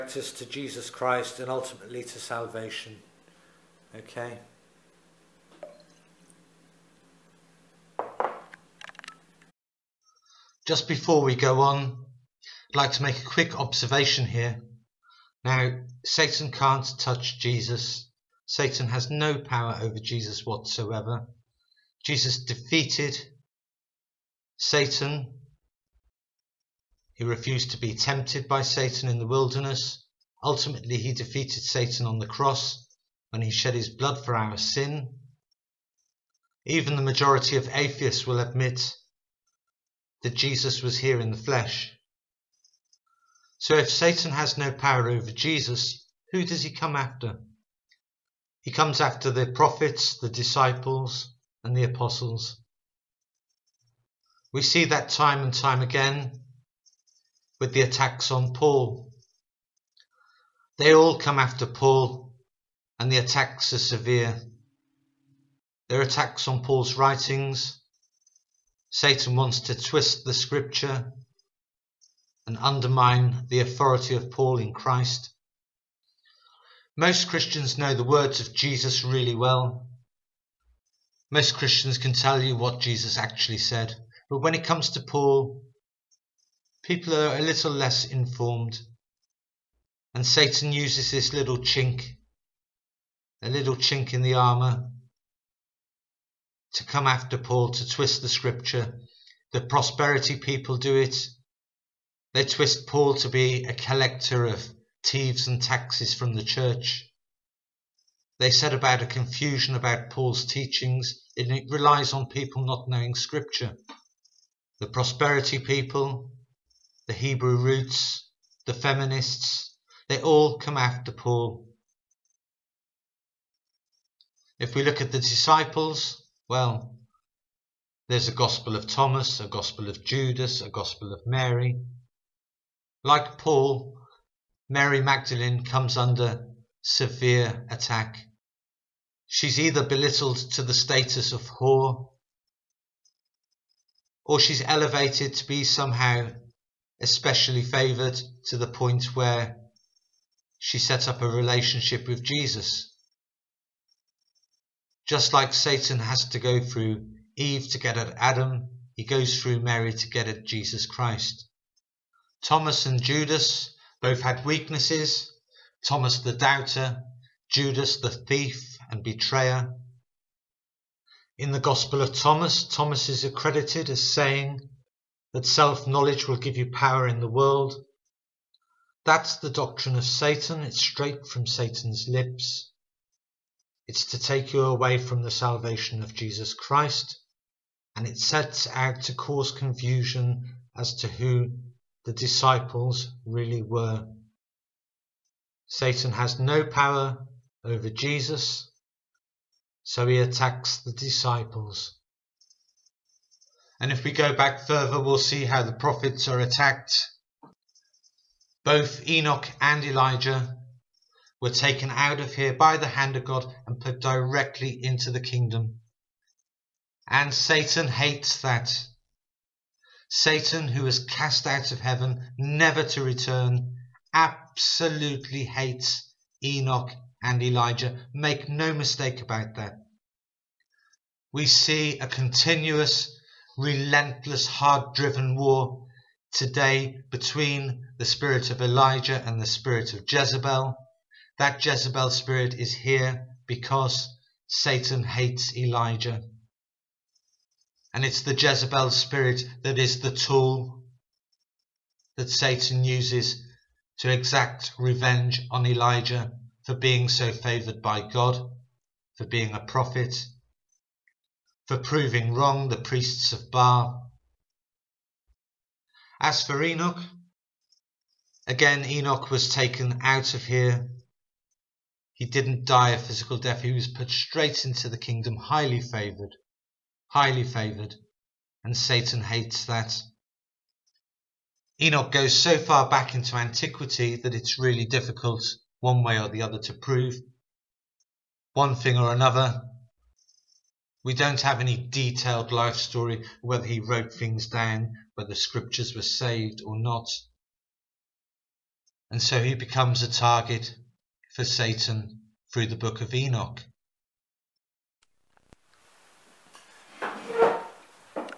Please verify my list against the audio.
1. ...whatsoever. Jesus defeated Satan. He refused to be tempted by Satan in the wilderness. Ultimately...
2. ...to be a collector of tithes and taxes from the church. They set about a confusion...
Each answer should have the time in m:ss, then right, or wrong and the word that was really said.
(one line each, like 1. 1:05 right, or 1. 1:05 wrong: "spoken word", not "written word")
1. 0:20 right
2. 1:43 right.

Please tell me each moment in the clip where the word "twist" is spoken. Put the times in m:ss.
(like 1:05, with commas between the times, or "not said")
1:09, 1:37, 1:42.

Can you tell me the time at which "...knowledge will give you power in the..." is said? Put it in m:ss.
2:55.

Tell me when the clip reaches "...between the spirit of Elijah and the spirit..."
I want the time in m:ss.
3:57.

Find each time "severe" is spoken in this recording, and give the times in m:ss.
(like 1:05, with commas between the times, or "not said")
1:03, 2:16.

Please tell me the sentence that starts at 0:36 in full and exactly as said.
Even the majority of atheists will admit that Jesus was here in the flesh.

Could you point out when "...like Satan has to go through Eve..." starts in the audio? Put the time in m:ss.
2:35.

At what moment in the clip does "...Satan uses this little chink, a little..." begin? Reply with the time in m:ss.
1:30.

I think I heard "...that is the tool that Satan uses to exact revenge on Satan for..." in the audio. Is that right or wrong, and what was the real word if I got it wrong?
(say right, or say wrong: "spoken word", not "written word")
wrong: "Elijah", not "Satan".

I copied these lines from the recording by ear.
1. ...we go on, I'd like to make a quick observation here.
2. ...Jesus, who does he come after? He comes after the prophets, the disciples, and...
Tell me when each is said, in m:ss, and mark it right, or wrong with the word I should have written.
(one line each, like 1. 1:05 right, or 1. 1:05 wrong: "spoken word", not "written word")
1. 0:11 right
2. 0:45 right.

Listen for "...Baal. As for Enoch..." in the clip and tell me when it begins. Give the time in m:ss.
4:23.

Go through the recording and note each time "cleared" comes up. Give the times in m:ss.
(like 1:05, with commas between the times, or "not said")
not said.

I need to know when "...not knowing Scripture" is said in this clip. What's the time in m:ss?
1:52.